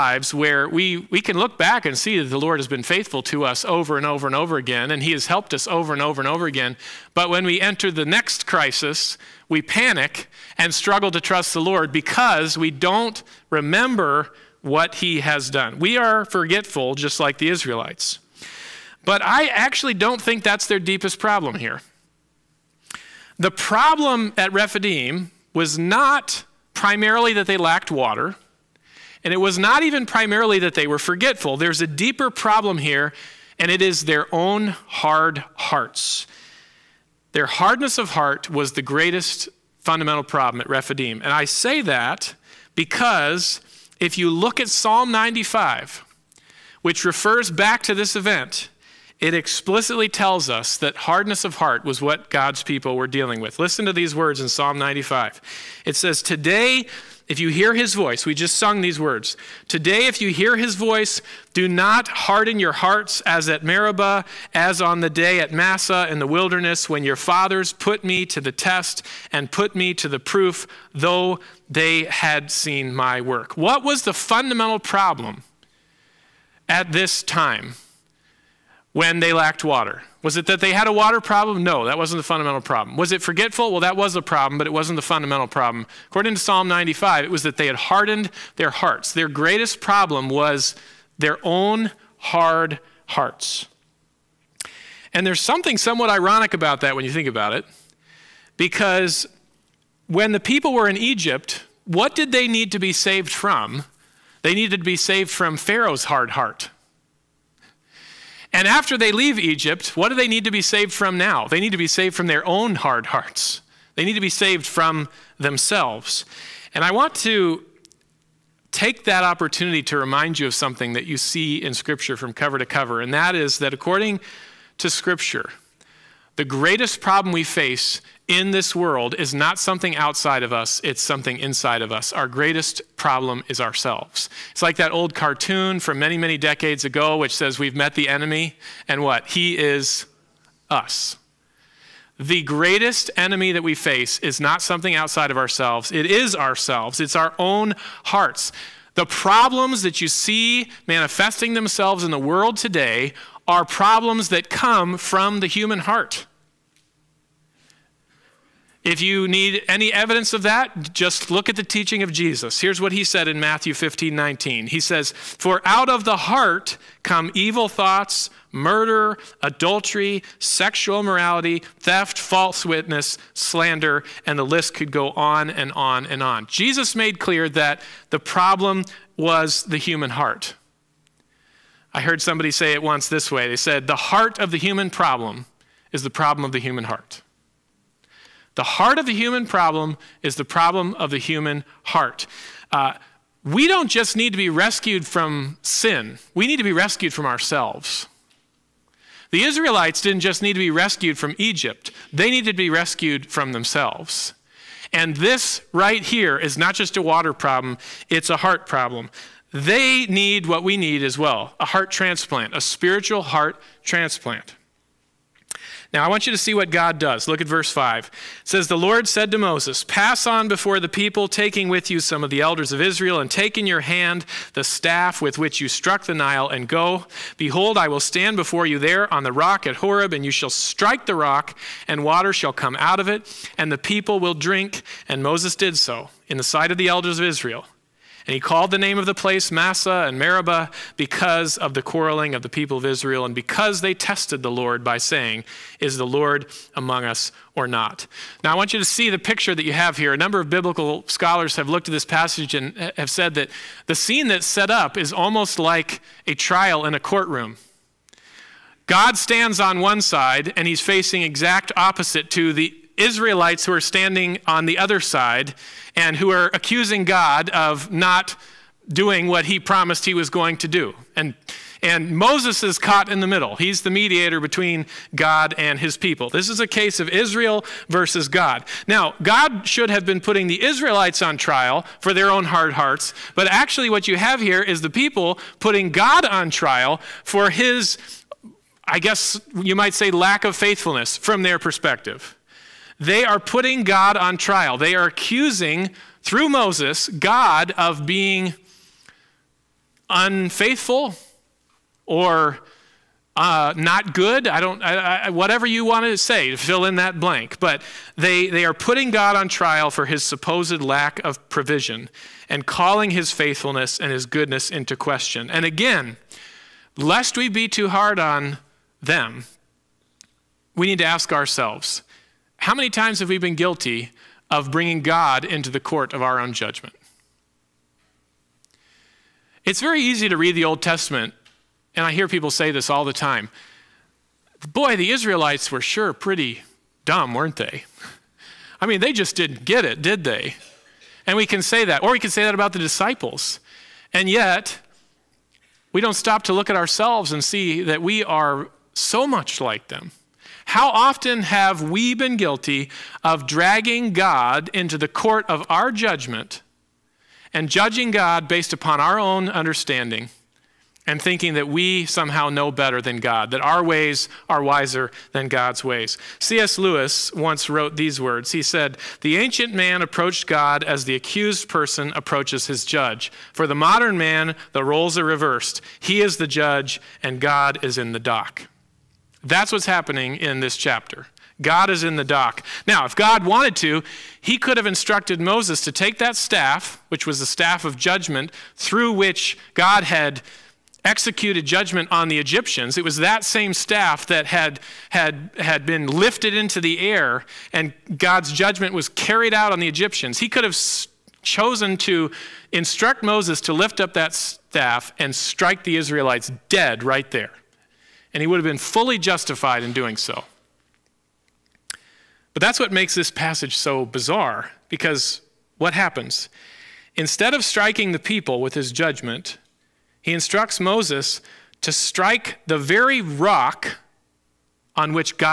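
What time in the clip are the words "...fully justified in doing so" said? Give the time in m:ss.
6:48.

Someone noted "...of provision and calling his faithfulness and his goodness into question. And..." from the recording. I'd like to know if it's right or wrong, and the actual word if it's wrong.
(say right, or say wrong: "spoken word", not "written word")
right.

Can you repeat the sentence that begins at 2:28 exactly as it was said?
The problems that you see manifesting themselves in the world today are problems that come from the human heart.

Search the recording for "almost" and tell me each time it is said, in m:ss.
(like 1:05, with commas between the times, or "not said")
4:15.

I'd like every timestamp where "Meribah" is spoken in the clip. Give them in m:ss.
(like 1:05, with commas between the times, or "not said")
1:03, 4:00.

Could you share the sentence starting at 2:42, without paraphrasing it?
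Here's what he said in Matthew 15 19.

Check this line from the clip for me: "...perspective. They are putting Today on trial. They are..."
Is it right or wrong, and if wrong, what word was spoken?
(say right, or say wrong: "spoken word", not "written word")
wrong: "God", not "Today".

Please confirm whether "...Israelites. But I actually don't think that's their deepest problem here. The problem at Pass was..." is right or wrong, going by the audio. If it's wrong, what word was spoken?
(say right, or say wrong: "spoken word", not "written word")
wrong: "Rephidim", not "Pass".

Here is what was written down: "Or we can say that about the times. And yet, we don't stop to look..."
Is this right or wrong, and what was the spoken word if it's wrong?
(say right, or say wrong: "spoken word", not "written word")
wrong: "disciples", not "times".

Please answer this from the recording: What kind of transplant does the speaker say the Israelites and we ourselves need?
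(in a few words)
spiritual heart transplant.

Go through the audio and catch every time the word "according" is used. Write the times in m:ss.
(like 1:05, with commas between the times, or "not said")
1:26, 2:03.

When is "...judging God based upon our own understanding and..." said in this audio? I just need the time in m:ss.
5:57.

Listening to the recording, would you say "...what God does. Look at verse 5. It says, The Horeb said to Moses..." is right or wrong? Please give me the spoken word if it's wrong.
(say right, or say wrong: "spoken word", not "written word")
wrong: "Lord", not "Horeb".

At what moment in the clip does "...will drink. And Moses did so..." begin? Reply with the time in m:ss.
3:54.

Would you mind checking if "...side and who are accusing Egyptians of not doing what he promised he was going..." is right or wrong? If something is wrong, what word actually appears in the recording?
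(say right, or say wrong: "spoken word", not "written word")
wrong: "God", not "Egyptians".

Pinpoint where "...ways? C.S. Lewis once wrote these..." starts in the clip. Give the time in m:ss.
6:05.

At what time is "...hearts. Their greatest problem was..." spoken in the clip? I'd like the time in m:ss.
1:28.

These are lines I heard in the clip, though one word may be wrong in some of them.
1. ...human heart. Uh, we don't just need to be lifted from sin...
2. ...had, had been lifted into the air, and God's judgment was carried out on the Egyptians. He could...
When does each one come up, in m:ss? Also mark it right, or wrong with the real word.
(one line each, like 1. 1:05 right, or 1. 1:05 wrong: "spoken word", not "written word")
1. 3:11 wrong: "rescued", not "lifted"
2. 6:35 right.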